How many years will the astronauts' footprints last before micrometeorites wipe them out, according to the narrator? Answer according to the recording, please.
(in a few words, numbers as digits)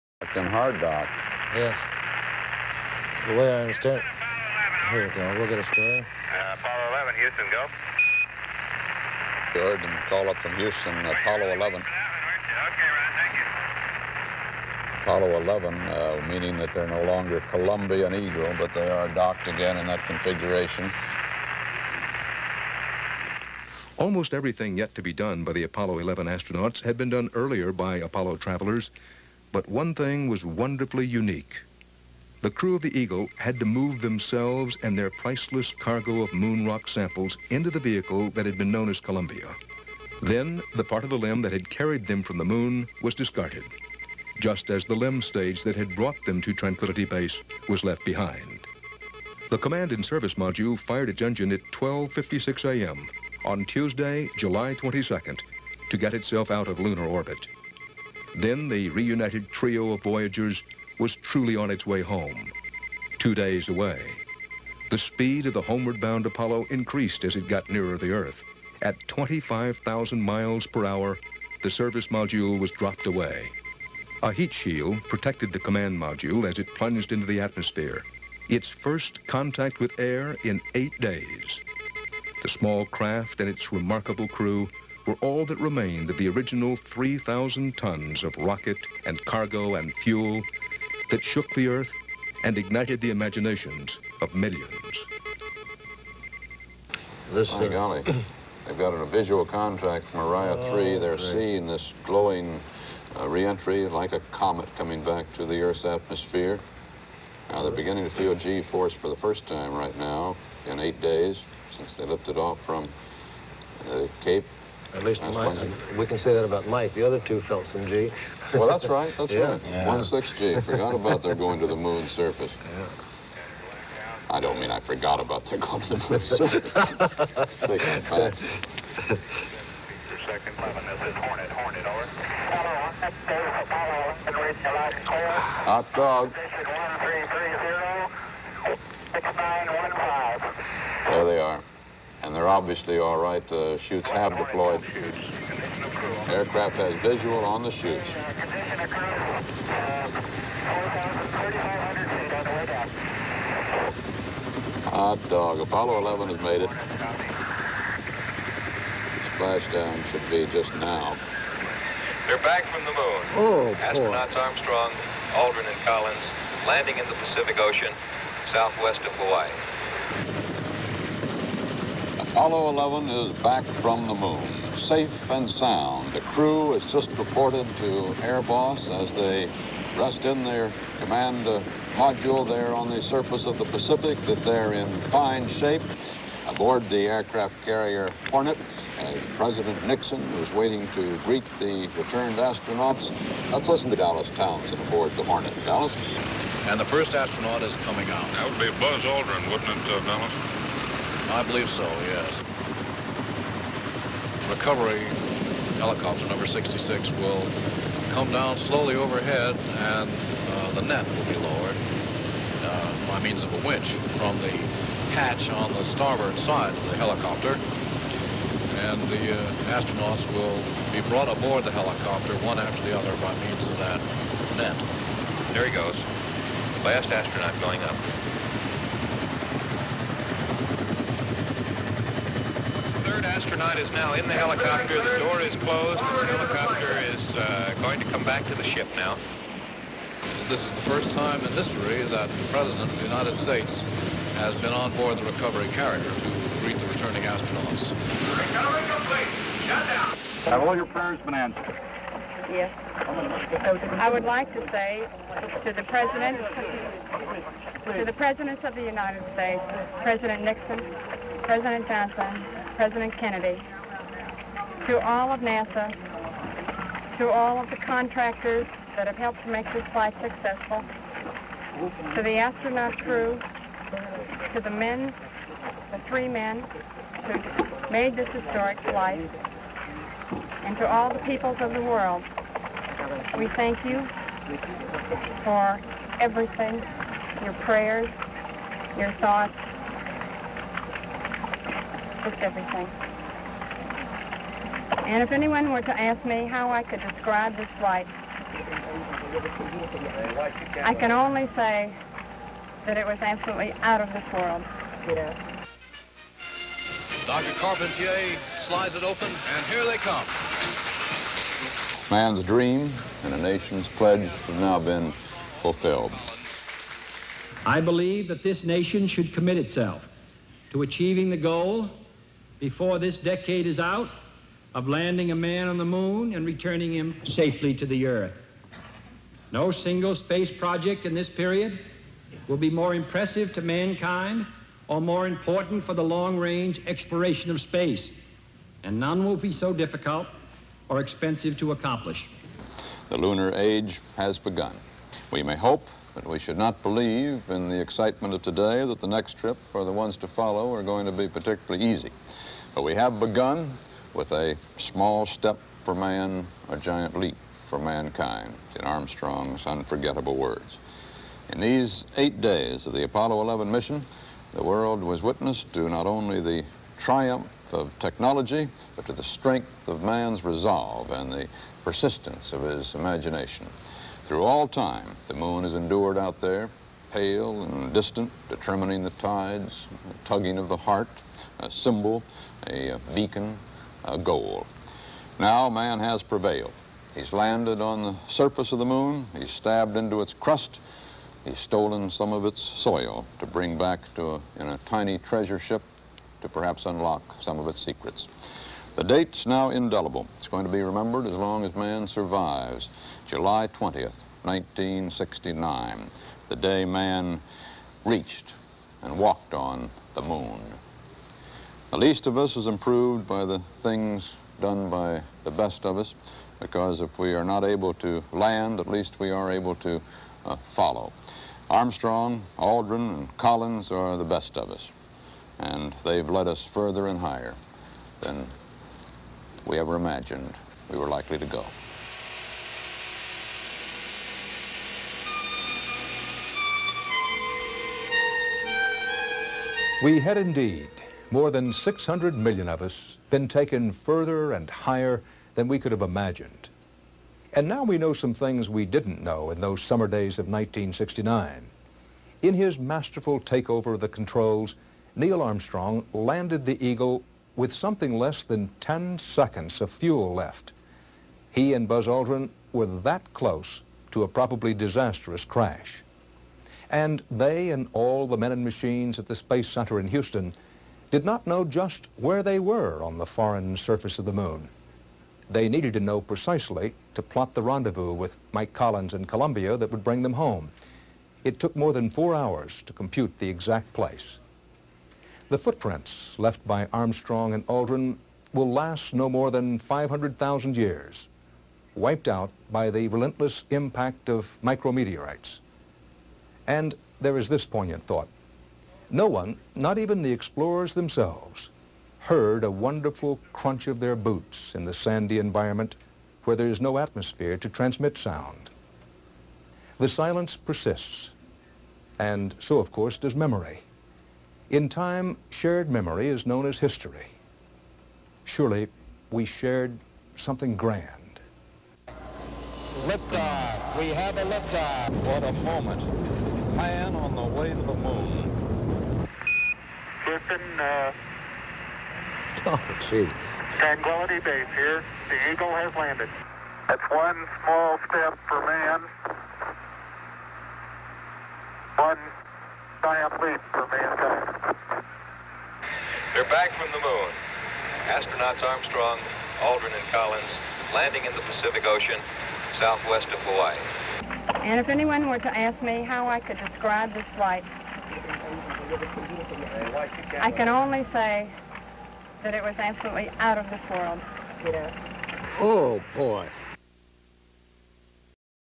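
500,000 years.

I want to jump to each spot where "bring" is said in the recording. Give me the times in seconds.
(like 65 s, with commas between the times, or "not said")
393 s, 480 s.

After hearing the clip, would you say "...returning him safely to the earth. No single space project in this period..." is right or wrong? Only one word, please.
right.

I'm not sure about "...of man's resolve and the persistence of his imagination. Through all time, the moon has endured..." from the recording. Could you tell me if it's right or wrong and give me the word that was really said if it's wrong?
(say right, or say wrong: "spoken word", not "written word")
right.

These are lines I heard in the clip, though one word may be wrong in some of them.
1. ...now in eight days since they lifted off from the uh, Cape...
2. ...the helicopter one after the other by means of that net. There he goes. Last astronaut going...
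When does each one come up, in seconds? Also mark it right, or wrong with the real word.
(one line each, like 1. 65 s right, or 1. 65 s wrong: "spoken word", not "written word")
1. 109 s right
2. 221 s right.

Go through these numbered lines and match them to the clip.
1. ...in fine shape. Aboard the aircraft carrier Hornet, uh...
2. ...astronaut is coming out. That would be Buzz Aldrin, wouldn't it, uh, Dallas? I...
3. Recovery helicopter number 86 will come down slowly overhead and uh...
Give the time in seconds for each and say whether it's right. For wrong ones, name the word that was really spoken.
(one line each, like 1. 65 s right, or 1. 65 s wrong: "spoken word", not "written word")
1. 184 s right
2. 197 s right
3. 204 s wrong: "66", not "86".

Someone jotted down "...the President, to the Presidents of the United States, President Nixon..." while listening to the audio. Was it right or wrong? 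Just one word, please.
right.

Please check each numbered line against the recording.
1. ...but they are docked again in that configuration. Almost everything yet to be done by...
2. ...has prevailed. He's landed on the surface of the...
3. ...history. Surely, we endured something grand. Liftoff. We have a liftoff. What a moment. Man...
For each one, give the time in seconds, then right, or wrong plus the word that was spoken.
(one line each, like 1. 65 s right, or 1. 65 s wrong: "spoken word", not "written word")
1. 18 s right
2. 385 s right
3. 516 s wrong: "shared", not "endured".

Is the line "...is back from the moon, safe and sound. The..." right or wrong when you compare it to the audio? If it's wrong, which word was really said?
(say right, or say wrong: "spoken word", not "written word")
right.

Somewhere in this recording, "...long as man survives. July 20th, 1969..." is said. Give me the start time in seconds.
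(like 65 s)
401 s.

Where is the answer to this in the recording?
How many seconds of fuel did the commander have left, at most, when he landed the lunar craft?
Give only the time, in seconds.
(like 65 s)
458 s.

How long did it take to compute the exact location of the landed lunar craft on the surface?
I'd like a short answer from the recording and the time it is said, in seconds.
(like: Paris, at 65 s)
more than four hours, at 481 s.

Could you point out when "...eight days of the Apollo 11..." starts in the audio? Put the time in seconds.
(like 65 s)
362 s.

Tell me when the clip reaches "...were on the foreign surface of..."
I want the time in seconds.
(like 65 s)
472 s.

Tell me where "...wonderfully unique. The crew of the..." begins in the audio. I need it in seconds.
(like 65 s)
30 s.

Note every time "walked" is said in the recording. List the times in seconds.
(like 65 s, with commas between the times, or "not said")
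409 s.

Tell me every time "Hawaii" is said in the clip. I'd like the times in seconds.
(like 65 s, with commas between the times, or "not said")
169 s, 553 s.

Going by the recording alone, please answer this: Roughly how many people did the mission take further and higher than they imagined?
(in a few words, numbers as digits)
more than 600 million.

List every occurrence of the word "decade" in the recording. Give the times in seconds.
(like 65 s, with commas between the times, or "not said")
323 s.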